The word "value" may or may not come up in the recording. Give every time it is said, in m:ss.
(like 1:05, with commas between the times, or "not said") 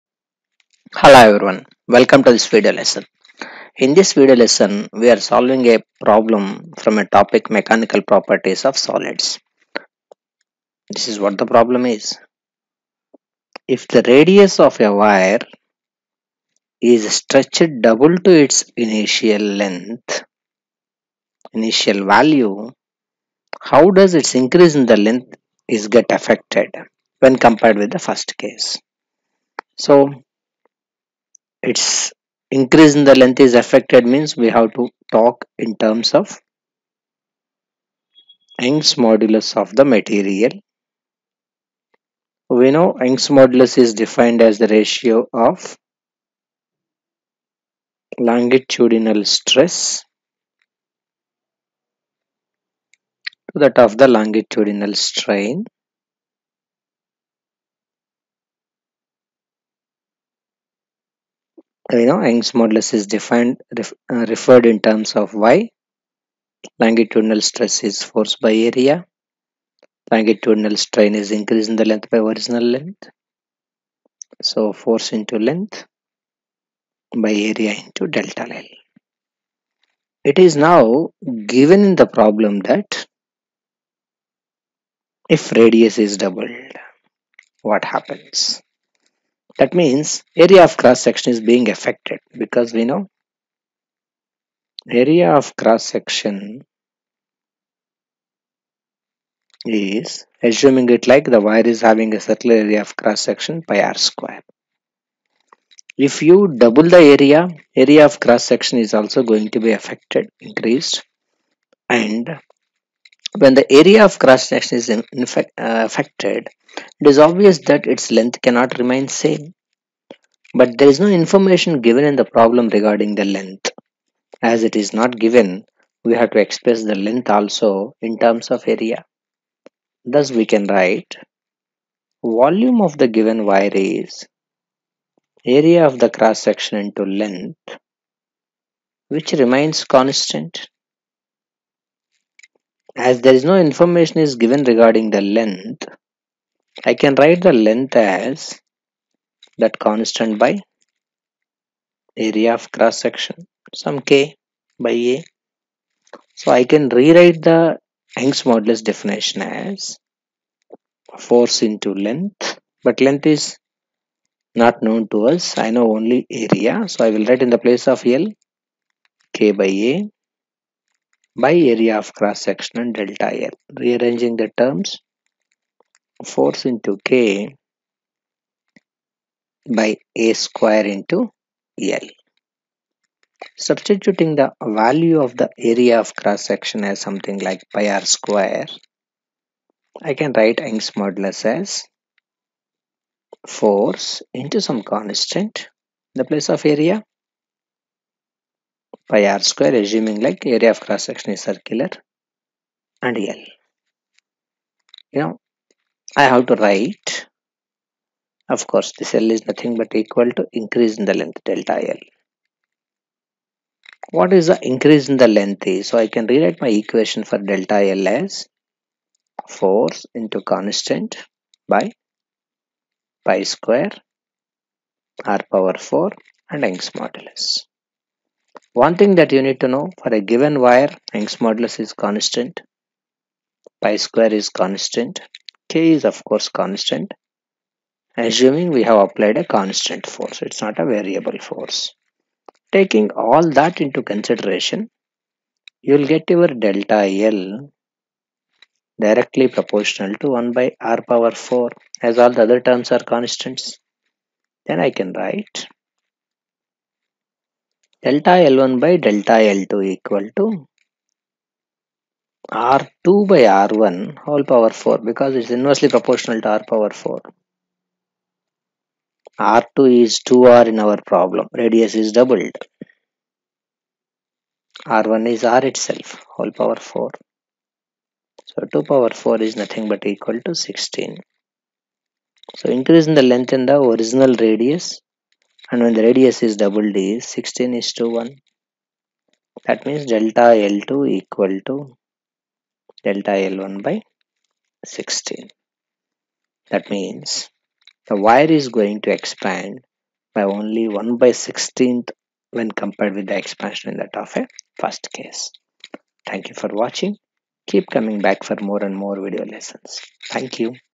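0:22, 3:04.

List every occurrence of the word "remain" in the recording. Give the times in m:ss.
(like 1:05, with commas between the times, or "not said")
1:58, 2:19.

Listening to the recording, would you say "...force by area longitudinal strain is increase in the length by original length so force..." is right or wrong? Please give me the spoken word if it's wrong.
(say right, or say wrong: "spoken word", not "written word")
right.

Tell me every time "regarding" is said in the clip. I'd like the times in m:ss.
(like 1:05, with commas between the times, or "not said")
2:02, 2:24.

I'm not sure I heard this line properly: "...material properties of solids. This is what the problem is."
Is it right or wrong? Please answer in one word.
wrong.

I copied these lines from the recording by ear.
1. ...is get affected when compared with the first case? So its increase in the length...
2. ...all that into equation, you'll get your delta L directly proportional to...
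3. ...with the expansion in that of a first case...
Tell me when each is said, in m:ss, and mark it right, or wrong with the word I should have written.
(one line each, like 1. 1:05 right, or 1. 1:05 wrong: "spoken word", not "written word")
1. 0:25 right
2. 4:03 wrong: "consideration", not "equation"
3. 5:03 right.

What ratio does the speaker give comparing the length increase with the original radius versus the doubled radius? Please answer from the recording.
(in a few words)
16 to 1.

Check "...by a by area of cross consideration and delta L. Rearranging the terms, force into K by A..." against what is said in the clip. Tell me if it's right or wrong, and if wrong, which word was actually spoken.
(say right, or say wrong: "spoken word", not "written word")
wrong: "section", not "consideration".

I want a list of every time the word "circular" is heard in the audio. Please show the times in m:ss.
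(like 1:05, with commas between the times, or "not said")
1:42, 3:21.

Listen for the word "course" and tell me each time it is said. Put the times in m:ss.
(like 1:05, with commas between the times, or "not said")
3:28, 3:56.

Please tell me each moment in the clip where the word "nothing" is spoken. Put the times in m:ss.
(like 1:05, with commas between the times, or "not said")
3:29, 4:39.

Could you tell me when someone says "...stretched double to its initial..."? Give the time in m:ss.
0:17.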